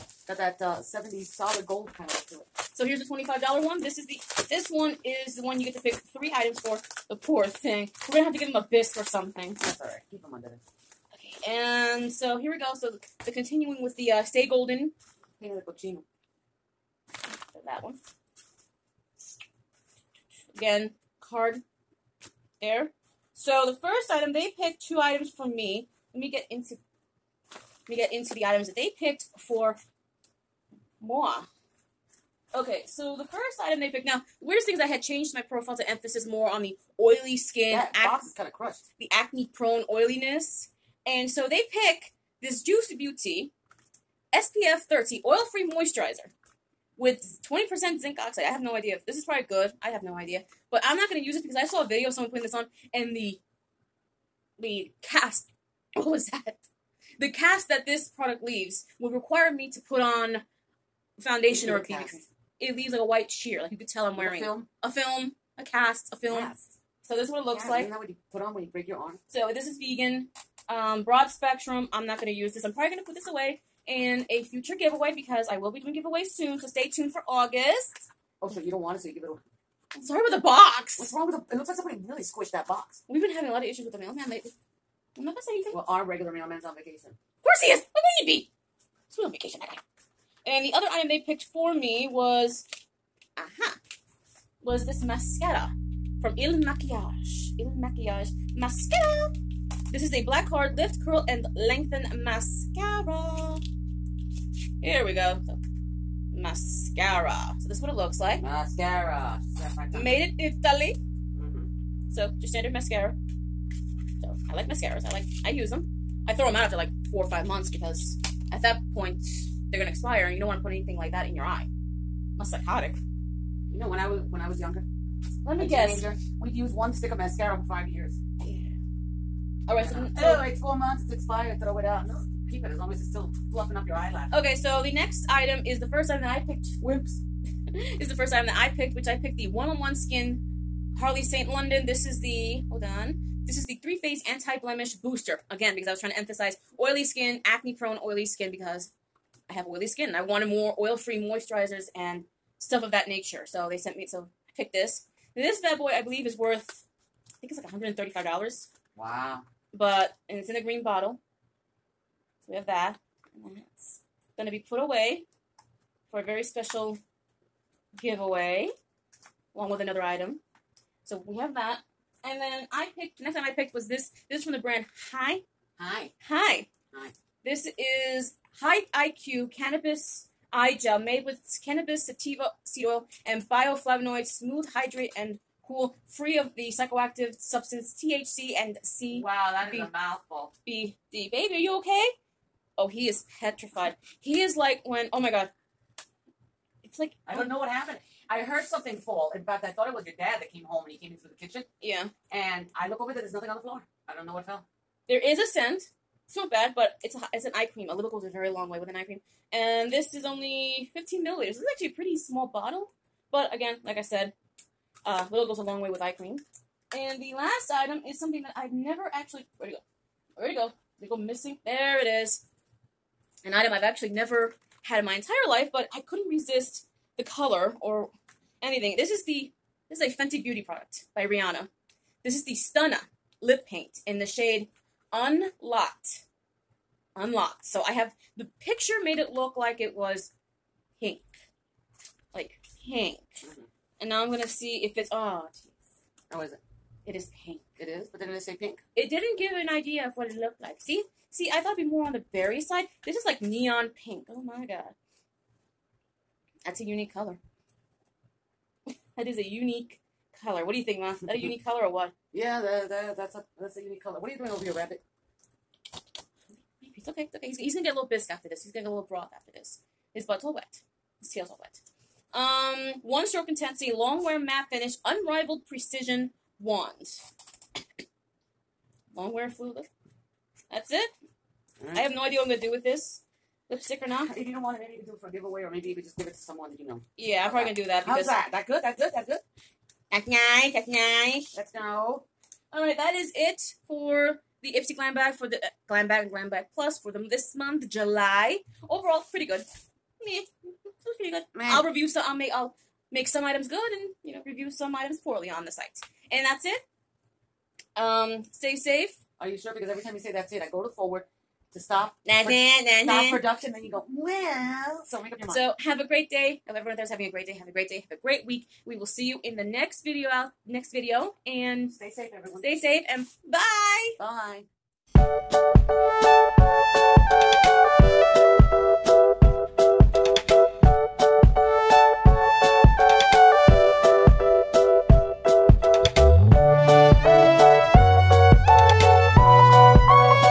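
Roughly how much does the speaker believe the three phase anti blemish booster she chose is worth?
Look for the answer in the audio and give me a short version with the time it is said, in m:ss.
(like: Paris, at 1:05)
$135, at 2:37.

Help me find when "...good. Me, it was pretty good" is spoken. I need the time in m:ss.
4:59.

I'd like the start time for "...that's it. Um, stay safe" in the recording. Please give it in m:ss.
5:06.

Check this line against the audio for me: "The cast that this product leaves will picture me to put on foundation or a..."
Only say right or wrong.
wrong.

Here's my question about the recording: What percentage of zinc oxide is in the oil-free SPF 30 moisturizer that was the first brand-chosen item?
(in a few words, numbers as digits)
20%.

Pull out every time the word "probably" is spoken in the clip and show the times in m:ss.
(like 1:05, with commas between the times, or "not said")
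0:49, 1:12, 4:47.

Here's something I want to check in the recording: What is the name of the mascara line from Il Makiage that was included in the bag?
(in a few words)
Black Card.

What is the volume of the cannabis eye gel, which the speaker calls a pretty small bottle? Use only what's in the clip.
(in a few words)
15 milliliters.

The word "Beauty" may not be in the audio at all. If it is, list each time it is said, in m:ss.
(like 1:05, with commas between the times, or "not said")
0:42, 3:50.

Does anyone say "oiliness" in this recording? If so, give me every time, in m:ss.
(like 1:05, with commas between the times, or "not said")
0:39.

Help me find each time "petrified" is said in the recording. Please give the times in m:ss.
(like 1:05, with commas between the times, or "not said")
3:13.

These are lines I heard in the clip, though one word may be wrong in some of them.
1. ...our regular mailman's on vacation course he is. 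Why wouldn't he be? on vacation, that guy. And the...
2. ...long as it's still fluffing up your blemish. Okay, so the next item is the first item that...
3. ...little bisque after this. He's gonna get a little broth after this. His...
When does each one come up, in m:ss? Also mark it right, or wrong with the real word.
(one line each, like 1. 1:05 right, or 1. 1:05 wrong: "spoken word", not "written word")
1. 1:25 right
2. 2:12 wrong: "eyelash", not "blemish"
3. 4:27 right.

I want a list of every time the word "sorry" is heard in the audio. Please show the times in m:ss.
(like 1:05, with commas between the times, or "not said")
1:20.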